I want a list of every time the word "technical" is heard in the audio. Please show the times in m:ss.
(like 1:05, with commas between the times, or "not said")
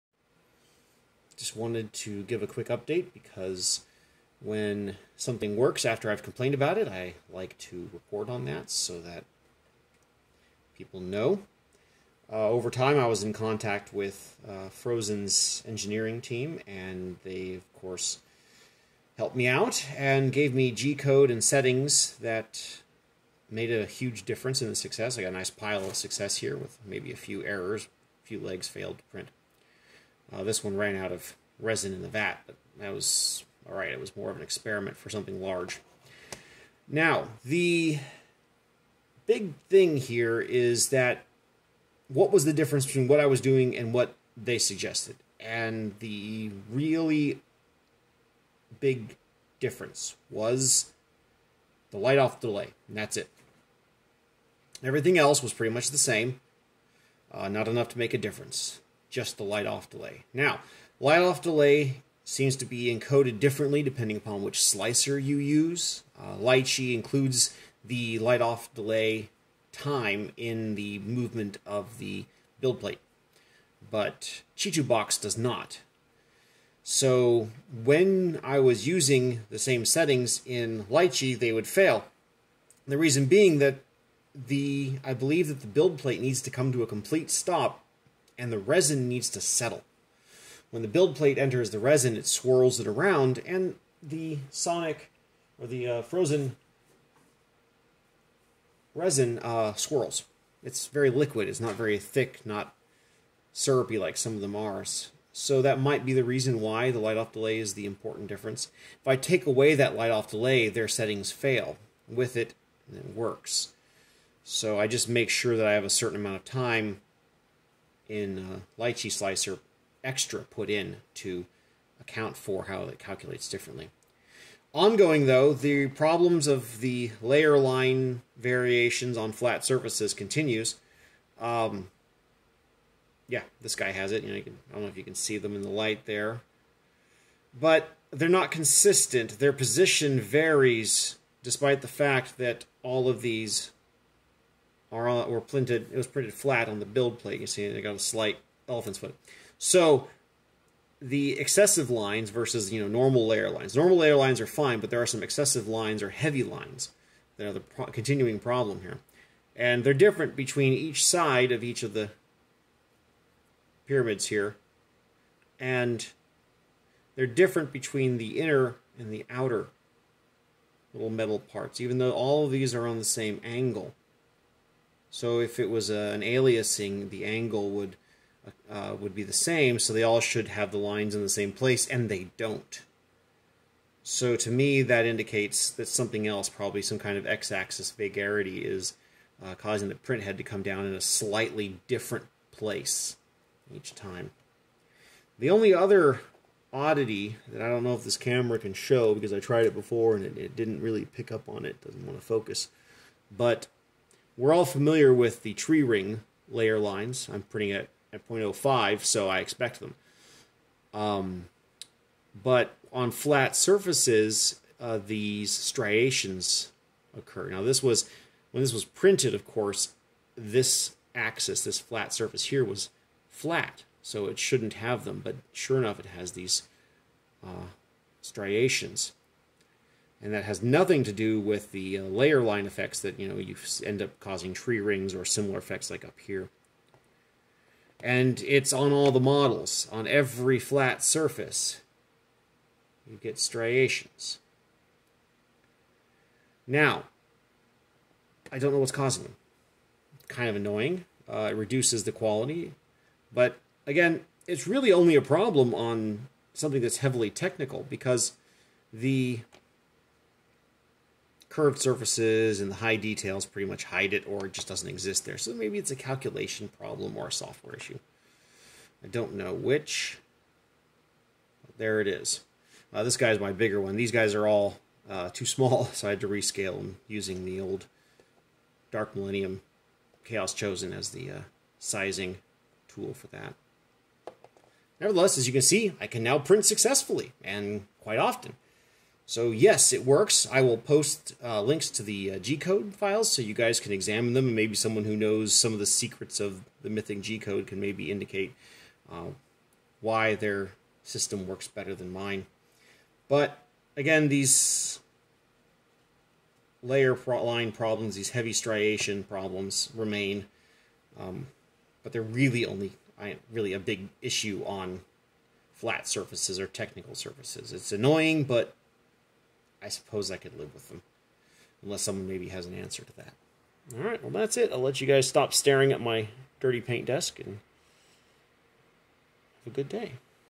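4:17, 5:16.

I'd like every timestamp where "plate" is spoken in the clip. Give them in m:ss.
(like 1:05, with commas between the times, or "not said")
1:12, 1:25, 1:31, 2:27.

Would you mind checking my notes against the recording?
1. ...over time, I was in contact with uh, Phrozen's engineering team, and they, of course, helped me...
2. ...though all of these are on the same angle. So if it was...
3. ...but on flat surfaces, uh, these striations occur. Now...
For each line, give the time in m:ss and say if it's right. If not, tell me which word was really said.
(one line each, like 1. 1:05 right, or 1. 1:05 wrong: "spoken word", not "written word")
1. 0:12 right
2. 2:51 right
3. 3:32 right.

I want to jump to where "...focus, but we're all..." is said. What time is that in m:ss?
3:22.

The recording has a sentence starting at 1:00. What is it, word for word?
Now, light off delay seems to be encoded differently depending upon which slicer you use.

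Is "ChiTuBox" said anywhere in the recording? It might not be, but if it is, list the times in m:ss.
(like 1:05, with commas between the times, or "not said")
1:14.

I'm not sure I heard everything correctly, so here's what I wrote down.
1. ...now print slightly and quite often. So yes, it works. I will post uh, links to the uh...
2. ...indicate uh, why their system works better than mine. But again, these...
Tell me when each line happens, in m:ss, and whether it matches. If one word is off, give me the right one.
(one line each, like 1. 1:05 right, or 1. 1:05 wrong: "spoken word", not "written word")
1. 4:46 wrong: "successfully", not "slightly"
2. 4:58 right.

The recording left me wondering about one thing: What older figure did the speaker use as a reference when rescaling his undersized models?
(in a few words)
Dark Millennium Chaos Chosen.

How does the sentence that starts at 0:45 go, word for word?
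And the really big difference was the light off delay, and that's it.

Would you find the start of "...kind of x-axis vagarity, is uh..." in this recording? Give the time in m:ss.
3:06.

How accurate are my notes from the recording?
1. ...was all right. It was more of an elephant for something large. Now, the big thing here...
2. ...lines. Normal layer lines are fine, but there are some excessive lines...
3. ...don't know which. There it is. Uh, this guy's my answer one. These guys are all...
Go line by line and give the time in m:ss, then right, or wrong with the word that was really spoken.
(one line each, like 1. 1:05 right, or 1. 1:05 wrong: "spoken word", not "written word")
1. 0:32 wrong: "experiment", not "elephant"
2. 2:33 right
3. 4:29 wrong: "bigger", not "answer".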